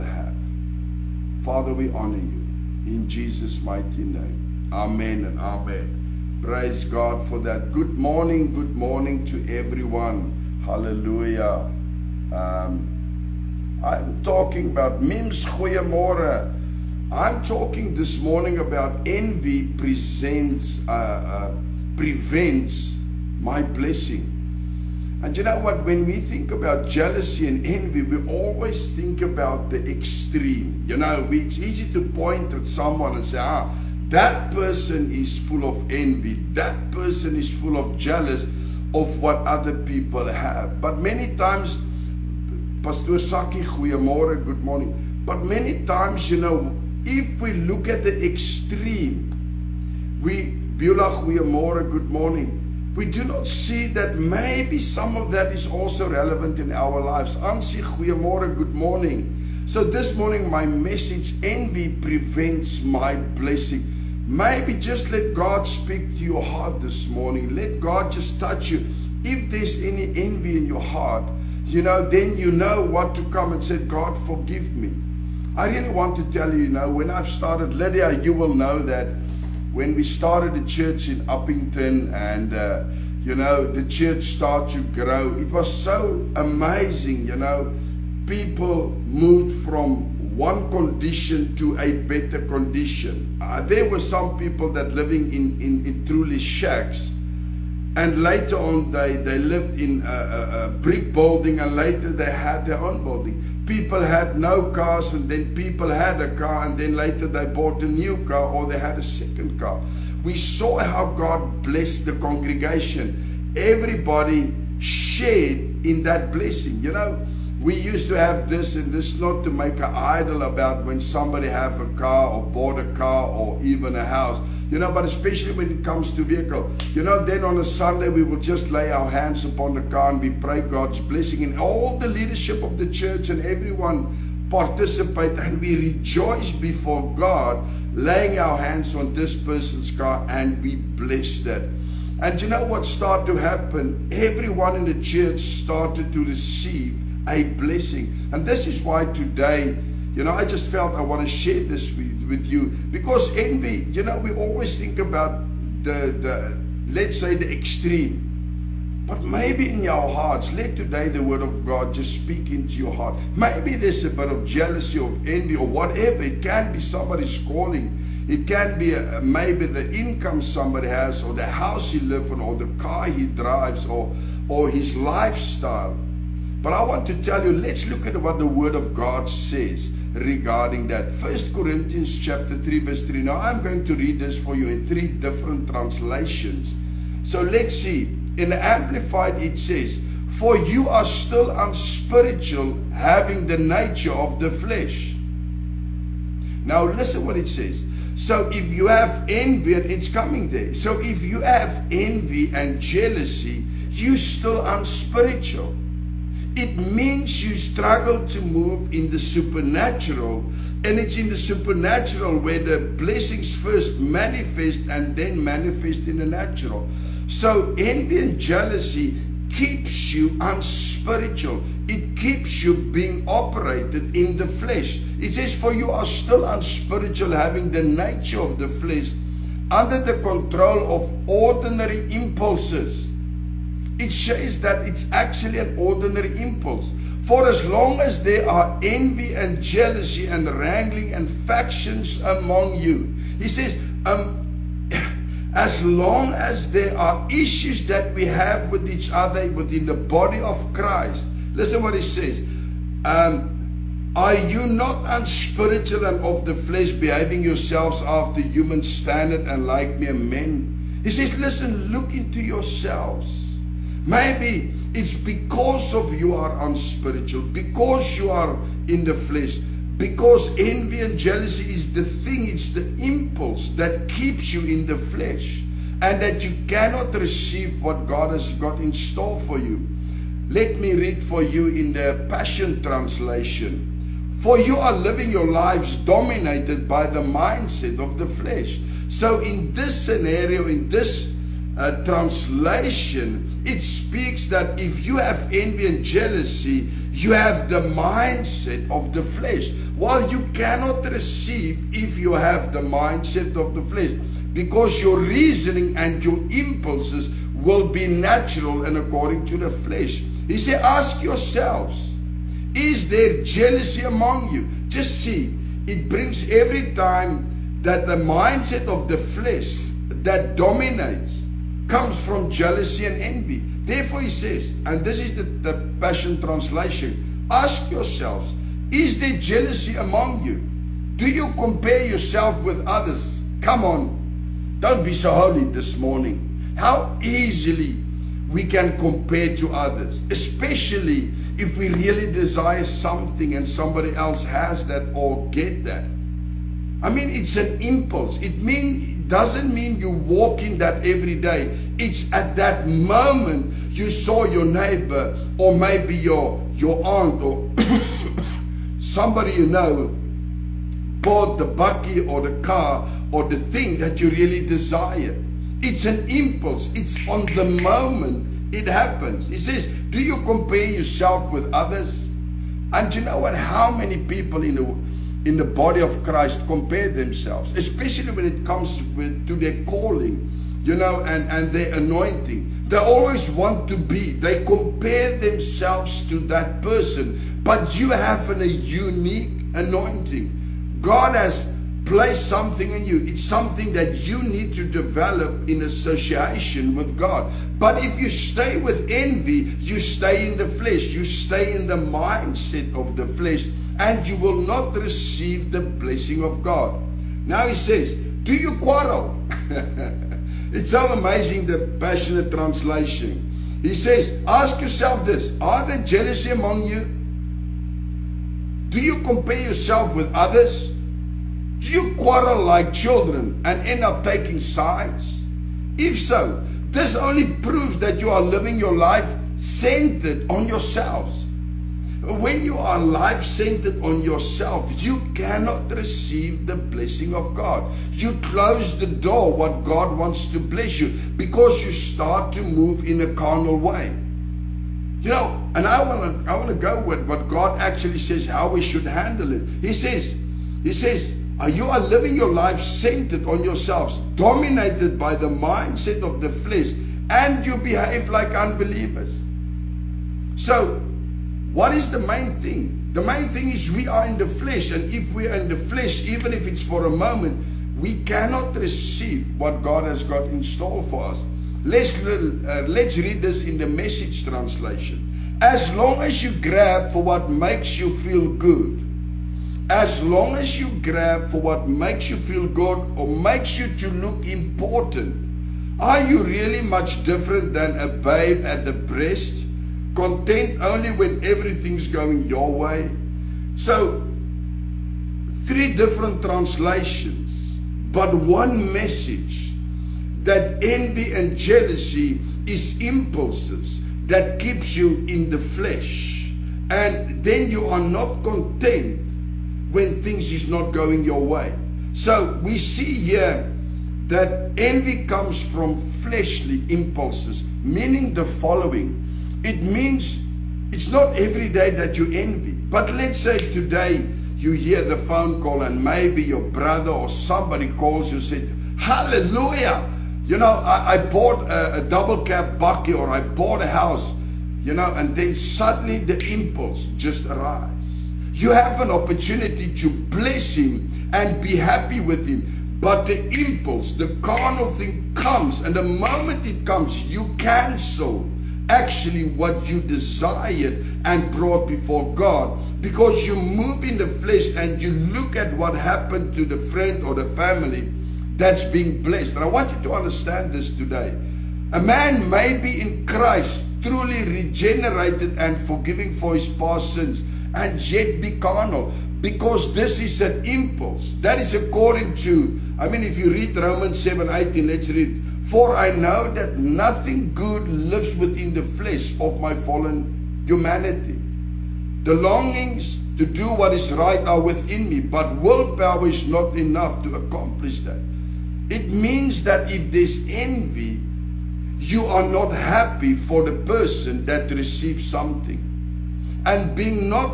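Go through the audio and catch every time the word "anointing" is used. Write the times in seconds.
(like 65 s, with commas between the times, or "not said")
381 s, 389 s.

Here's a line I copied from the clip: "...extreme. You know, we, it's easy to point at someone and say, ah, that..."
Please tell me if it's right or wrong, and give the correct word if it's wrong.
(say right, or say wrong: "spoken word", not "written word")
right.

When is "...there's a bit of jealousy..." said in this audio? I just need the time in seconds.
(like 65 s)
163 s.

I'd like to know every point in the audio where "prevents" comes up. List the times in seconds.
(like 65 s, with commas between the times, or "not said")
21 s, 61 s.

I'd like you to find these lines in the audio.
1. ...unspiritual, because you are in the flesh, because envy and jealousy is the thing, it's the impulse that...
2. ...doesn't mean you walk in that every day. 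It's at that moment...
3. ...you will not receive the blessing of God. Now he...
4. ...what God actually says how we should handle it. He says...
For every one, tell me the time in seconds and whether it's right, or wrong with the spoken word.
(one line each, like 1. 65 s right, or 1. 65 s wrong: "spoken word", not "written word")
1. 266 s right
2. 349 s right
3. 404 s right
4. 447 s right.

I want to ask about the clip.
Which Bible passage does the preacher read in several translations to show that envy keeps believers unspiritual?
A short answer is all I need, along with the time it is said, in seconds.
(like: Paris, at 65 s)
1 Corinthians 3:3, at 181 s.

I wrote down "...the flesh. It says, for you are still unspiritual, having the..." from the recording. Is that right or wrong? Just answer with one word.
right.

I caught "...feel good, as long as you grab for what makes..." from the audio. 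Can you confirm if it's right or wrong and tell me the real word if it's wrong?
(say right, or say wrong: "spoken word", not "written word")
right.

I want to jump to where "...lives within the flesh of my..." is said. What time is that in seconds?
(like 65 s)
577 s.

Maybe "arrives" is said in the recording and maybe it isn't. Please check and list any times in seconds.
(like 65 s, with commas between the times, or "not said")
537 s.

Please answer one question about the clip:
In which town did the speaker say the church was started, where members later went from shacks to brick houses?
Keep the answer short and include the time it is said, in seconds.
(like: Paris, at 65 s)
Uppington, at 81 s.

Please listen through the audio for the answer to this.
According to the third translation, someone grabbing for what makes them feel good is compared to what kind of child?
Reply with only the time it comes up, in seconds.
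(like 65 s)
487 s.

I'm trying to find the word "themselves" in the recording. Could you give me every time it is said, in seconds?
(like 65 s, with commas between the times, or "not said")
377 s, 385 s.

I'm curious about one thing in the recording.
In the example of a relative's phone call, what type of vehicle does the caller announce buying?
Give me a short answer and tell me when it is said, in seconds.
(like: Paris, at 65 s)
double cab bakkie, at 532 s.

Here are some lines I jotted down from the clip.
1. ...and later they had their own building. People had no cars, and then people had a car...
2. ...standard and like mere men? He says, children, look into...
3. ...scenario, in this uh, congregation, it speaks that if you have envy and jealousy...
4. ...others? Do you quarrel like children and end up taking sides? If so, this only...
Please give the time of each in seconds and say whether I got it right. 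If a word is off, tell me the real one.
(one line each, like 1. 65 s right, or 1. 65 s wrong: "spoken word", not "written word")
1. 101 s right
2. 258 s wrong: "listen", not "children"
3. 290 s wrong: "translation", not "congregation"
4. 420 s right.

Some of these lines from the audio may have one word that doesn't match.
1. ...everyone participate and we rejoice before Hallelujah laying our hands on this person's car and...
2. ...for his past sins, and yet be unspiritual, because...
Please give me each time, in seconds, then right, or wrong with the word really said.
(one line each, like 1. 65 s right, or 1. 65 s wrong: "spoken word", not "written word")
1. 133 s wrong: "God", not "Hallelujah"
2. 566 s wrong: "carnal", not "unspiritual".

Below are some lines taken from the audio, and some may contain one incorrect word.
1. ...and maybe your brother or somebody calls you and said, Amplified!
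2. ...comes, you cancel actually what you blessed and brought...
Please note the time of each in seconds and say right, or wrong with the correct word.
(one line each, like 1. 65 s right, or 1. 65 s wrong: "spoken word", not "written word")
1. 525 s wrong: "Hallelujah", not "Amplified"
2. 546 s wrong: "desired", not "blessed".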